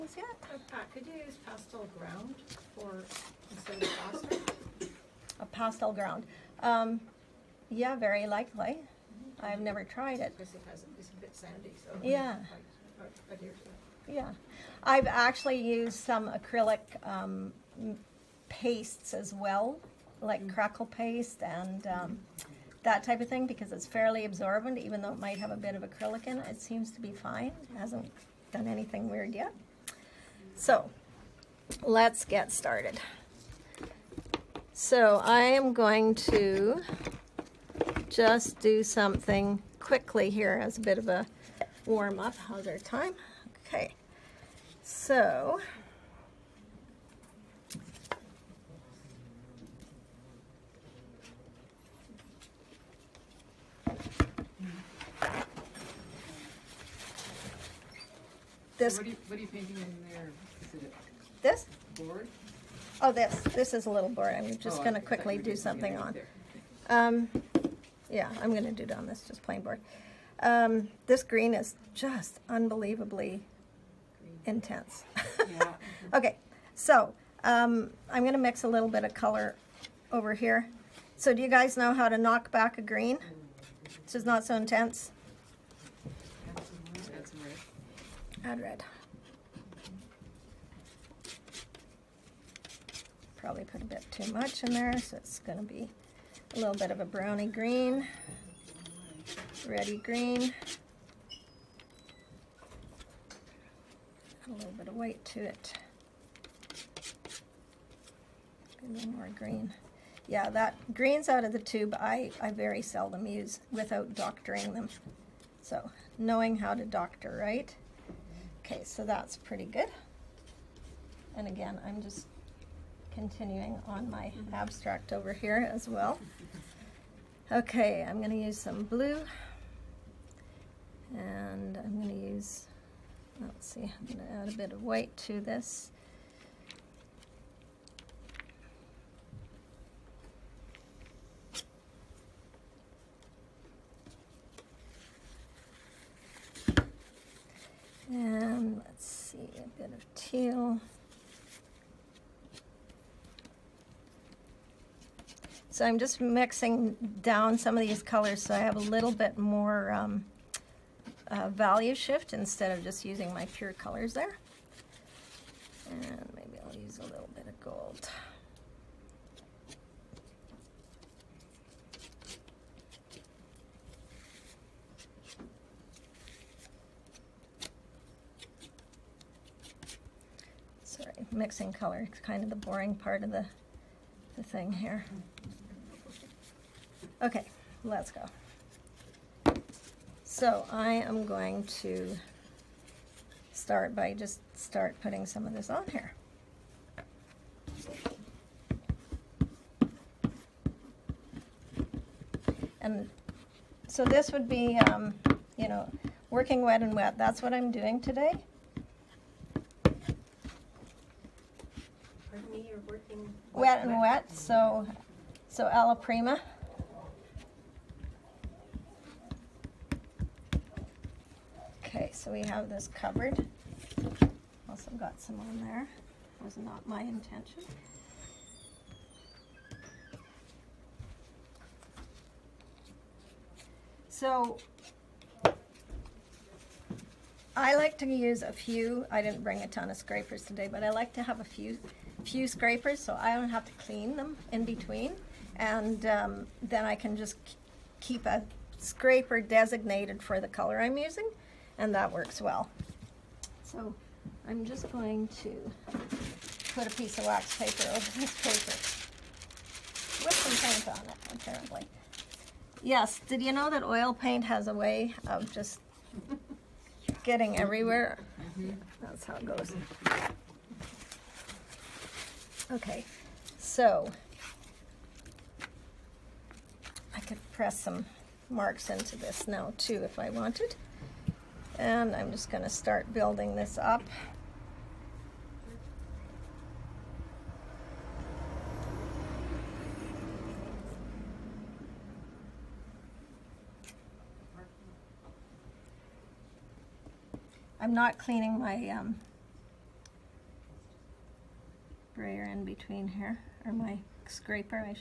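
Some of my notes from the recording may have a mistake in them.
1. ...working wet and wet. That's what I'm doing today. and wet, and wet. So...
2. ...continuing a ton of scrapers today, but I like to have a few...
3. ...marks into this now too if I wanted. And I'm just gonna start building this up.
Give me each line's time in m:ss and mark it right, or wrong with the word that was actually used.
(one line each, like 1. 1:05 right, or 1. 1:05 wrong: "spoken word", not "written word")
1. 3:26 right
2. 3:59 wrong: "bring", not "continuing"
3. 4:38 right.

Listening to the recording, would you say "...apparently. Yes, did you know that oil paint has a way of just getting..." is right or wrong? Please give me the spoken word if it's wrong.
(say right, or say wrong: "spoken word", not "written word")
right.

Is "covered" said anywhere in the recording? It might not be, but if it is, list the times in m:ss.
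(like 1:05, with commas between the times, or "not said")
3:42.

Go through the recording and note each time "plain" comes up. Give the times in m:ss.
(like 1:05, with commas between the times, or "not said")
1:09.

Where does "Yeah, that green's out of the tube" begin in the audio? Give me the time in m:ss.
1:50.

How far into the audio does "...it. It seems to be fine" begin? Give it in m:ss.
0:26.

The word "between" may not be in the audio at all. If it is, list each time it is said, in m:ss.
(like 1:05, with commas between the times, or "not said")
4:04, 5:02.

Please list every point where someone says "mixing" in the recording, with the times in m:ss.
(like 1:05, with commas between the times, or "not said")
2:36, 3:01.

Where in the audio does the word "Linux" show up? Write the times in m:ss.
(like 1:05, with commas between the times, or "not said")
not said.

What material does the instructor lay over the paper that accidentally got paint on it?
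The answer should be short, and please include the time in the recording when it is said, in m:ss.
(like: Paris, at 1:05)
Wax paper, at 4:17.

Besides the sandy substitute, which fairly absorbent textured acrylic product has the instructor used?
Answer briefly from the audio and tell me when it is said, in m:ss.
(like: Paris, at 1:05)
Crackle paste, at 0:20.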